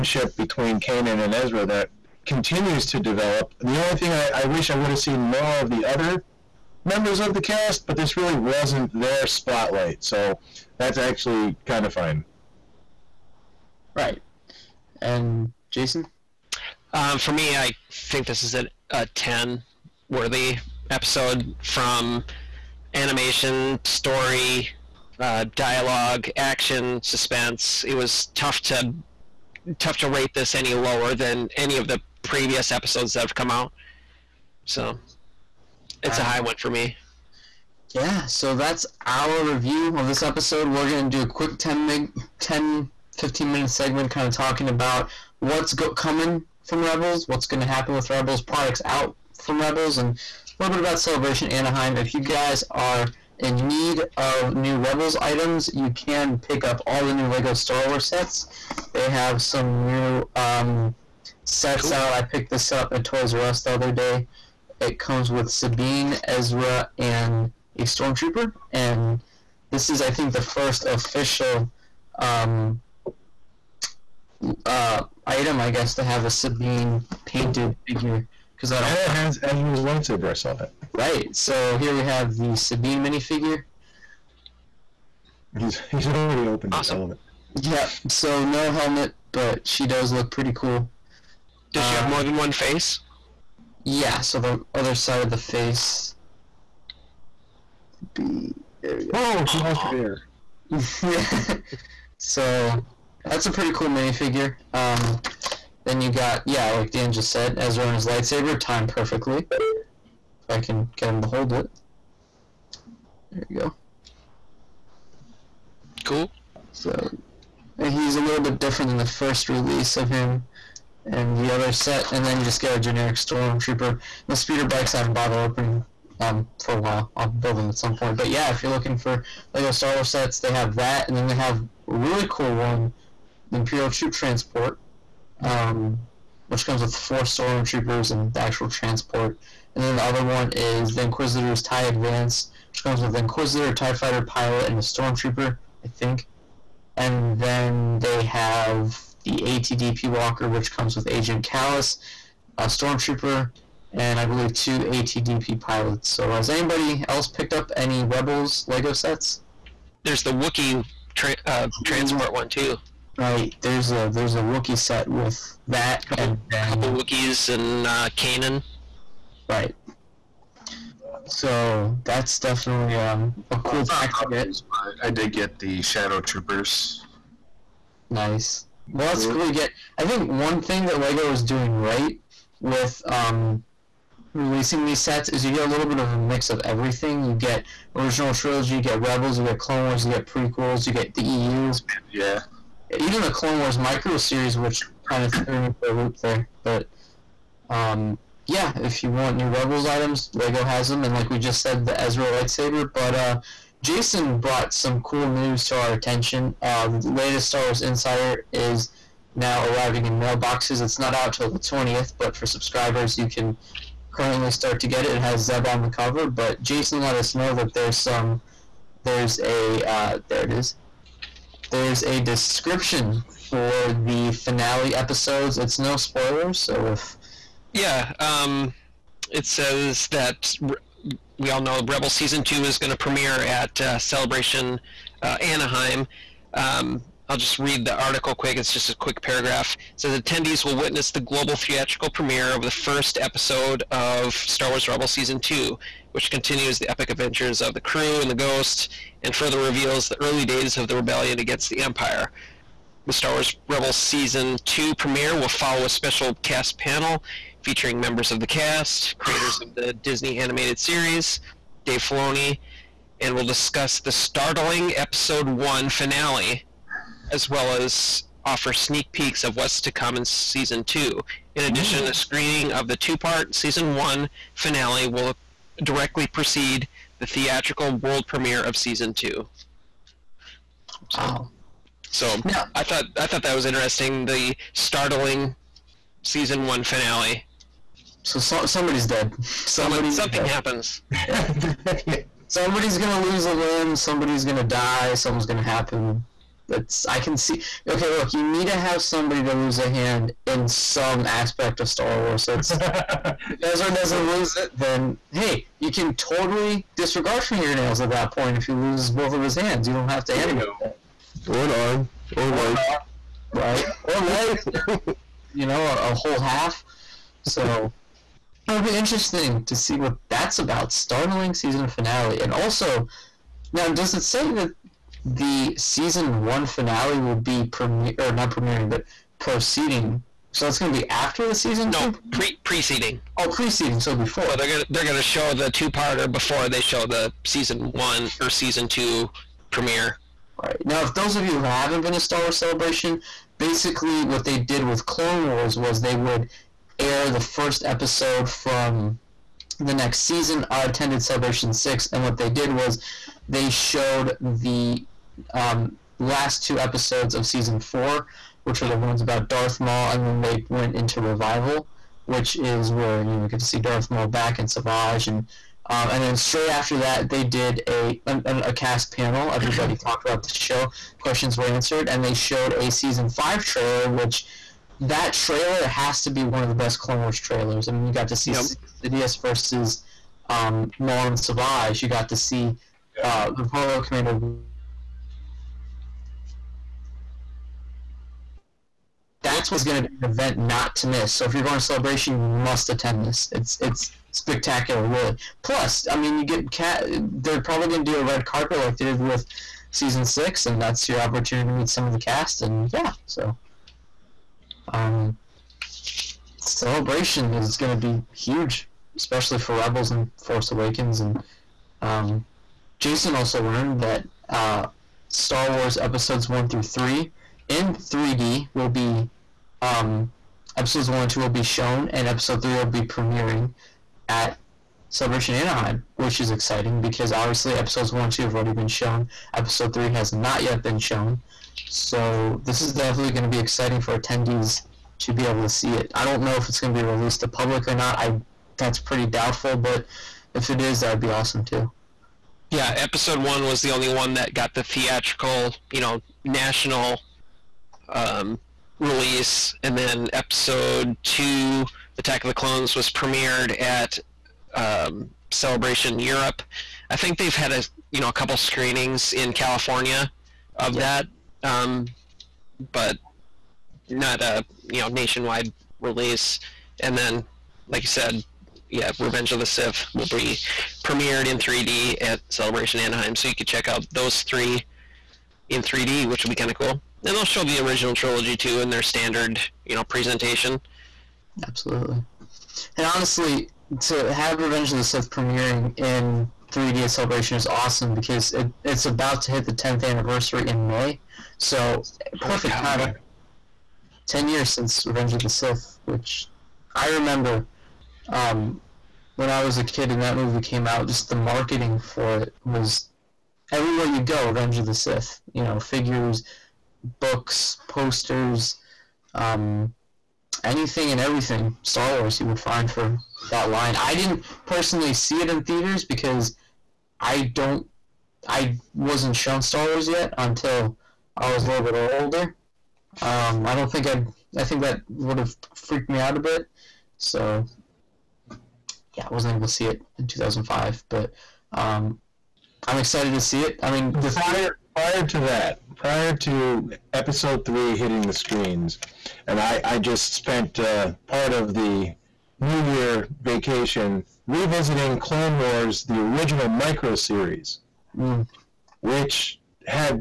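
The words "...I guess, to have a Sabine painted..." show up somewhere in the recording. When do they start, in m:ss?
1:15.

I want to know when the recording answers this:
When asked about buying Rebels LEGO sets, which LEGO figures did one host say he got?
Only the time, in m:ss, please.
2:55.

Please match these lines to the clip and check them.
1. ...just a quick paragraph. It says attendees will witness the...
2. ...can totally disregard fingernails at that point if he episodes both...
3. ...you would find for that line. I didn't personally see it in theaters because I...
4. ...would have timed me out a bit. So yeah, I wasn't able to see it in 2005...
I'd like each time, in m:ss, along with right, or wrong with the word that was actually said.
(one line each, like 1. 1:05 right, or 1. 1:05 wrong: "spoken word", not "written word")
1. 3:58 right
2. 5:05 wrong: "loses", not "episodes"
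3. 8:32 right
4. 8:45 wrong: "freaked", not "timed".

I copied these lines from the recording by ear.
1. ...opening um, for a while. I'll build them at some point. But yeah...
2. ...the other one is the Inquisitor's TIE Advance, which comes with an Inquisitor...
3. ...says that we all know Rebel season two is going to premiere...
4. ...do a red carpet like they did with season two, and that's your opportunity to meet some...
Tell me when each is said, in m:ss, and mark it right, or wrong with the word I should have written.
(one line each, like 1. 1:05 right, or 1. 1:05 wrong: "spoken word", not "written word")
1. 2:05 right
2. 2:19 right
3. 3:49 right
4. 6:38 wrong: "six", not "two".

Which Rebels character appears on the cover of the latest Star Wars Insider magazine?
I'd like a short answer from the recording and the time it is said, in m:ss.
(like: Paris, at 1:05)
Zeb, at 3:35.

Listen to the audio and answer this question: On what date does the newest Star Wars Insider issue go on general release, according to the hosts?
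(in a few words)
the 20th.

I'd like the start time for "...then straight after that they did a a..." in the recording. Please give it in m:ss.
6:06.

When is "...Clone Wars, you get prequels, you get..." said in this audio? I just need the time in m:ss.
3:09.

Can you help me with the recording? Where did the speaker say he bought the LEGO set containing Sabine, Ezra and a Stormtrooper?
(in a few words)
Toys R Us.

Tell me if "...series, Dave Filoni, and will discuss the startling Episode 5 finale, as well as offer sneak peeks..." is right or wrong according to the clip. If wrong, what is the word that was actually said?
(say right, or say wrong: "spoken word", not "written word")
wrong: "1", not "5".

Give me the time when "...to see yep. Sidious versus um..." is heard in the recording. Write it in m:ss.
6:18.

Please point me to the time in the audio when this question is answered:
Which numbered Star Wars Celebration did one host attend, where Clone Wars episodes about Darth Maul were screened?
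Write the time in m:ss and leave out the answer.
5:51.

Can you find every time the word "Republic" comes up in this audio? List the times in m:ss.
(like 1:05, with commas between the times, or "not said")
6:23.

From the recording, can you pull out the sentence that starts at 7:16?
I don't know if it's going to be released to public or not.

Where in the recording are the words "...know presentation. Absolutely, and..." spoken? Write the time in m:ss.
7:59.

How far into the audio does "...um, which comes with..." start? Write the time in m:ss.
2:15.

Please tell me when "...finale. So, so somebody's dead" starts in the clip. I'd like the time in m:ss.
4:46.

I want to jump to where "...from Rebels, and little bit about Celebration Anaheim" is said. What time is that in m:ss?
0:49.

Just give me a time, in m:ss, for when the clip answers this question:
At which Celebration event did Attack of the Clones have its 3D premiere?
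7:35.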